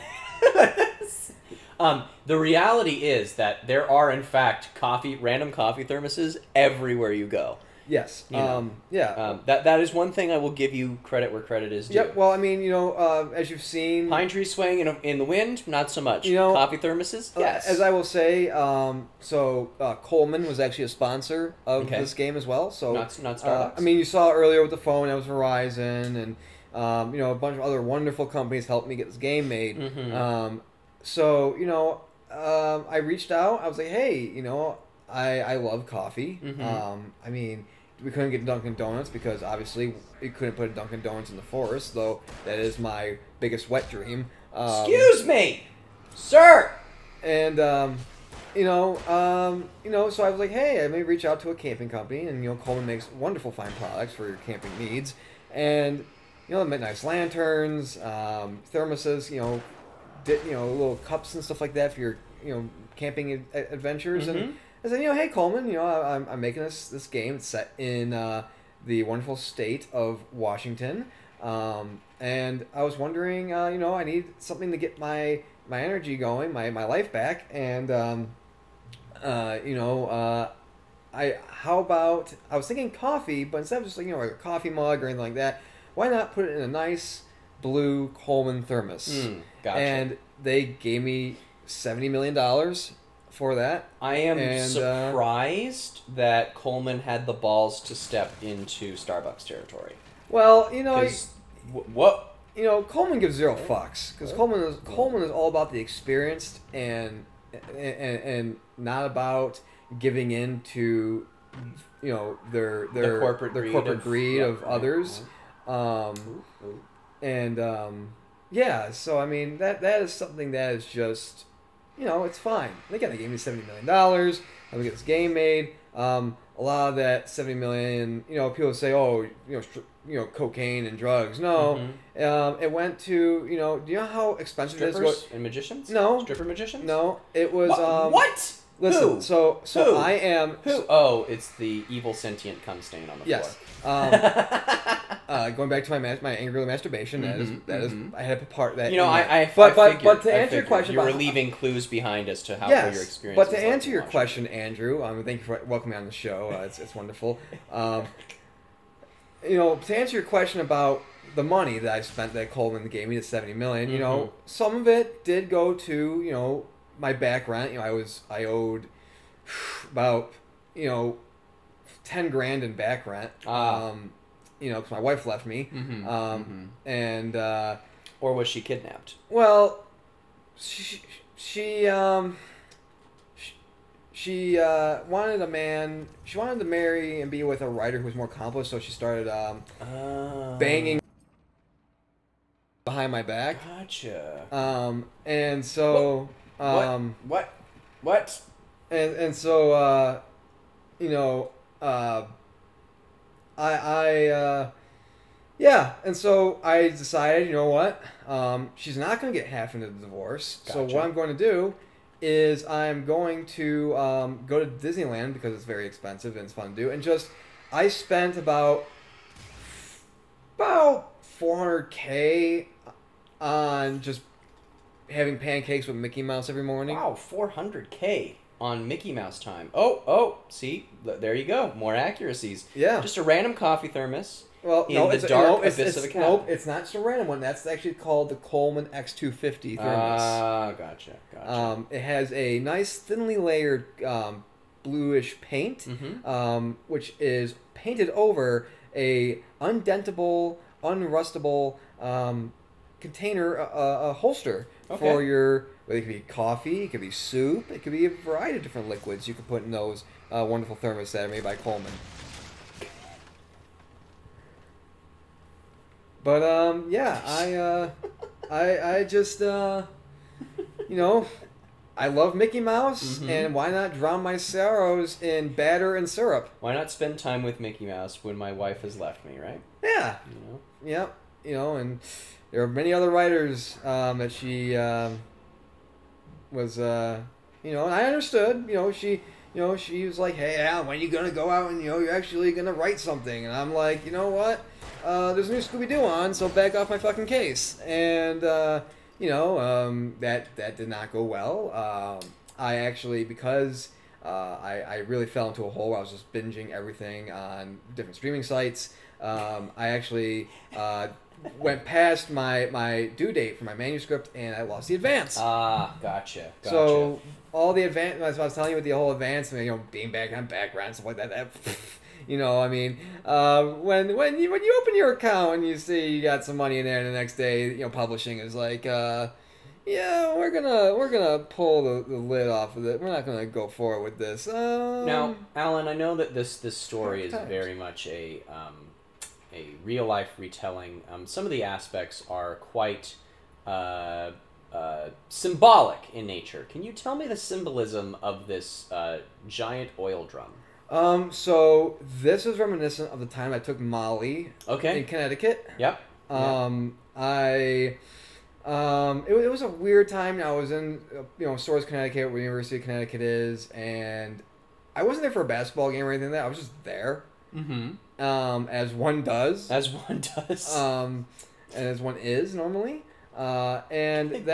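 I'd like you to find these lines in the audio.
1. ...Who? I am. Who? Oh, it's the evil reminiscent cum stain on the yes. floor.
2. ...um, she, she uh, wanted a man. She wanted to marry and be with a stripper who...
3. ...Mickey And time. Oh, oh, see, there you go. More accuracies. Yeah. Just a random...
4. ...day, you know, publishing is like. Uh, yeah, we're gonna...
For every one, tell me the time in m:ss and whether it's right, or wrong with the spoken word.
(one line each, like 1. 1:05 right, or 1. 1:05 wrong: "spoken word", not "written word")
1. 2:19 wrong: "sentient", not "reminiscent"
2. 3:01 wrong: "writer", not "stripper"
3. 3:48 wrong: "Mouse", not "And"
4. 5:27 right.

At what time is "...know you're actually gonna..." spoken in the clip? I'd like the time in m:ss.
4:51.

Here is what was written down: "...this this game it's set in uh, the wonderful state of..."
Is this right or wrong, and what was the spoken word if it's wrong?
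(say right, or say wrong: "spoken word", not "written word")
right.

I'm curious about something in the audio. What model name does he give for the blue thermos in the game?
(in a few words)
Coleman X250.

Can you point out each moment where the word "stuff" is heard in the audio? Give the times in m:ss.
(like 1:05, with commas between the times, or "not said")
1:01, 5:20.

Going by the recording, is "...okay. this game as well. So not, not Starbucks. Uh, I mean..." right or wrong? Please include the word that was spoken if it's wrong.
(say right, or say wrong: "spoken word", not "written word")
right.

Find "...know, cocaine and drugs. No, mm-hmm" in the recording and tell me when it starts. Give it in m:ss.
2:10.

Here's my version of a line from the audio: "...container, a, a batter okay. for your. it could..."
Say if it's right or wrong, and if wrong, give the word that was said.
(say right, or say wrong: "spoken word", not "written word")
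wrong: "holster", not "batter".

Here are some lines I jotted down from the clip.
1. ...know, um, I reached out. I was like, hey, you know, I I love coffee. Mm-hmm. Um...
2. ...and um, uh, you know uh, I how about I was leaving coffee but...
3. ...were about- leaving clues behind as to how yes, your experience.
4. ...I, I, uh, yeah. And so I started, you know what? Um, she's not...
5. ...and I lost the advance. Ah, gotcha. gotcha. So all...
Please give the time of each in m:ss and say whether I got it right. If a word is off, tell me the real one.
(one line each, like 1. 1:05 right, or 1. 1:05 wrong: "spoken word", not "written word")
1. 0:31 right
2. 1:17 wrong: "thinking", not "leaving"
3. 2:31 right
4. 3:23 wrong: "decided", not "started"
5. 5:14 right.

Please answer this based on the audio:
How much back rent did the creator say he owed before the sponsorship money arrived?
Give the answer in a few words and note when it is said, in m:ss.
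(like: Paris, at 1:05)
$10,000, at 2:52.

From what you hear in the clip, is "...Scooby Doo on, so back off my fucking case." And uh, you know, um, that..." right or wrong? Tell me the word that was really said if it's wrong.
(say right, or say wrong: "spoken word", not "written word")
right.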